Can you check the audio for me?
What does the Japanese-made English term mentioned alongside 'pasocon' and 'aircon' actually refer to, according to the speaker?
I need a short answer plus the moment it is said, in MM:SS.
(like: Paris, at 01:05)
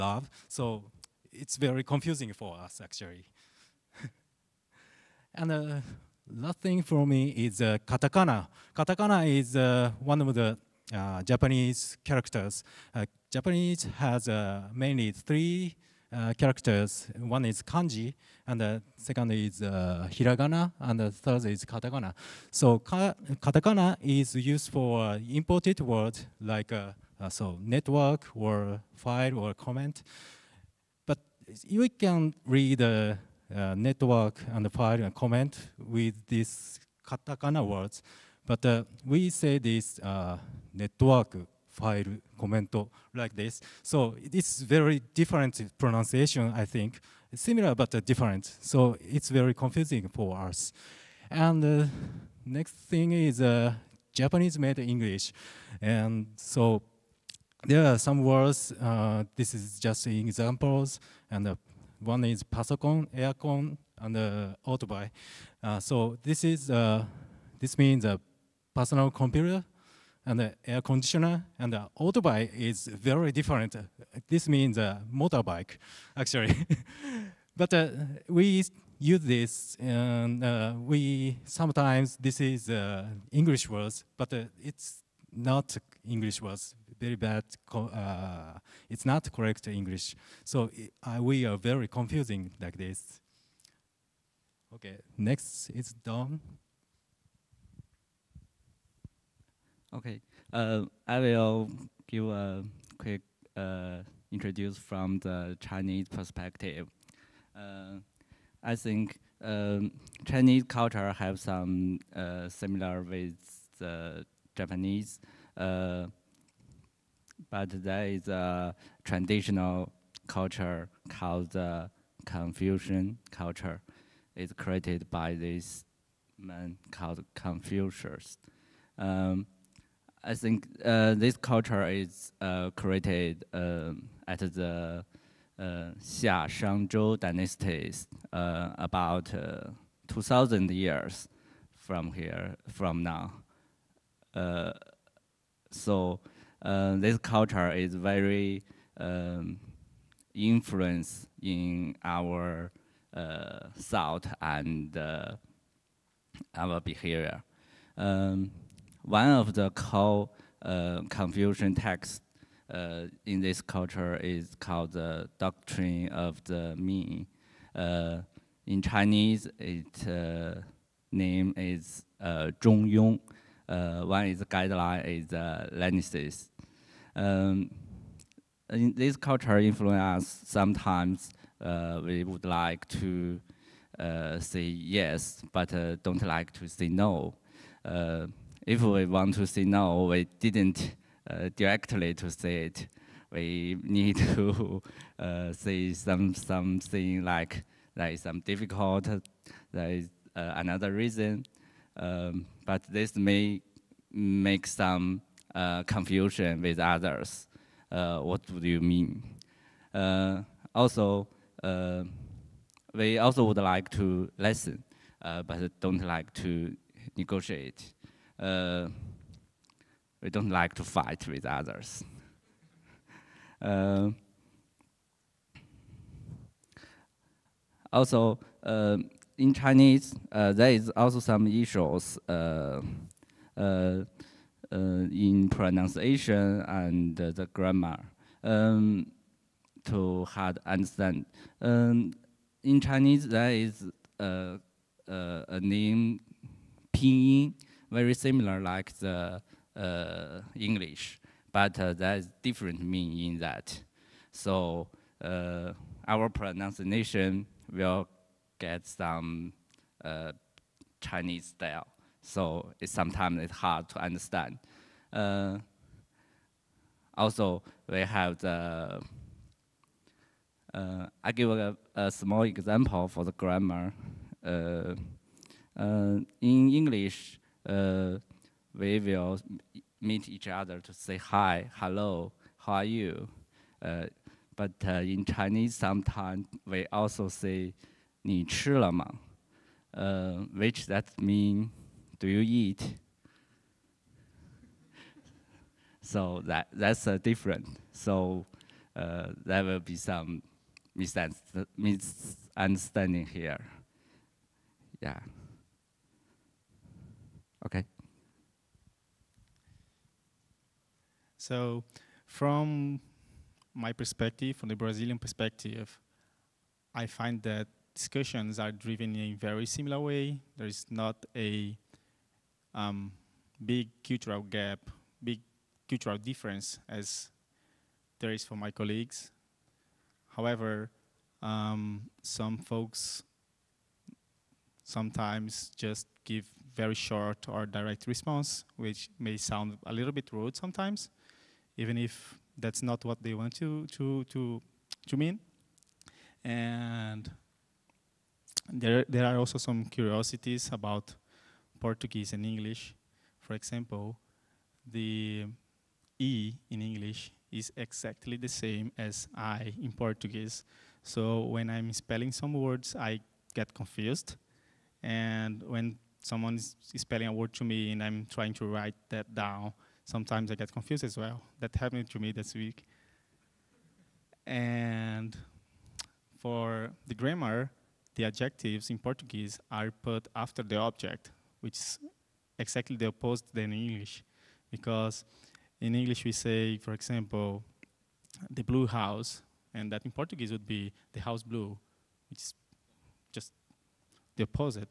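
a motorbike, at 01:14.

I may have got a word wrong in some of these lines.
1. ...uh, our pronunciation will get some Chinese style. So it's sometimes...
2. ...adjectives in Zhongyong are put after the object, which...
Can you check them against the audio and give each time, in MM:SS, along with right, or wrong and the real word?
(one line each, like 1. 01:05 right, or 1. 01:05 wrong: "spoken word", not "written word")
1. 04:15 right
2. 06:18 wrong: "Portuguese", not "Zhongyong".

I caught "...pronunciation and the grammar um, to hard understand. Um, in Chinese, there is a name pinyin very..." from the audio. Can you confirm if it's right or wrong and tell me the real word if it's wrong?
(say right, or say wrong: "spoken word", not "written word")
right.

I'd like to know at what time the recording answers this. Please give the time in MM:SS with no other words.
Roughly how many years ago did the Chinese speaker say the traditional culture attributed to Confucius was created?
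02:18.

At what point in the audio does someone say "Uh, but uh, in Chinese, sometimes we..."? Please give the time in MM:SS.
04:43.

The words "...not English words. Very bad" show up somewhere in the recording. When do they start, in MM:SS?
01:25.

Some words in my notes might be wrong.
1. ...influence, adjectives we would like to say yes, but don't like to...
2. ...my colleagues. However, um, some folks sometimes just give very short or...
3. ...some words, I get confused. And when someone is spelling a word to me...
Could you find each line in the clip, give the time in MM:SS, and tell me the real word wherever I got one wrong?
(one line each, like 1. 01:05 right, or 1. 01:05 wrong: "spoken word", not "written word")
1. 02:59 wrong: "sometimes", not "adjectives"
2. 05:28 right
3. 06:02 right.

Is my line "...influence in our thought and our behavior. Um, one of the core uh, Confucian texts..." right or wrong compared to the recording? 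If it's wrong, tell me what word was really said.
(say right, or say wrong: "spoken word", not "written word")
right.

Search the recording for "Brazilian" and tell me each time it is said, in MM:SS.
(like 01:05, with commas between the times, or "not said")
05:14.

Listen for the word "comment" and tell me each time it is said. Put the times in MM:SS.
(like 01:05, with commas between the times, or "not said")
00:29, 00:35, 00:42.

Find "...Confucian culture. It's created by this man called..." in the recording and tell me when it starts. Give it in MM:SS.
02:02.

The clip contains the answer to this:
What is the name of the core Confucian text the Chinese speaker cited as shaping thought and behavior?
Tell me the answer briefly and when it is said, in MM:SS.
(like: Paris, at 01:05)
the Doctrine of the Mean, at 02:44.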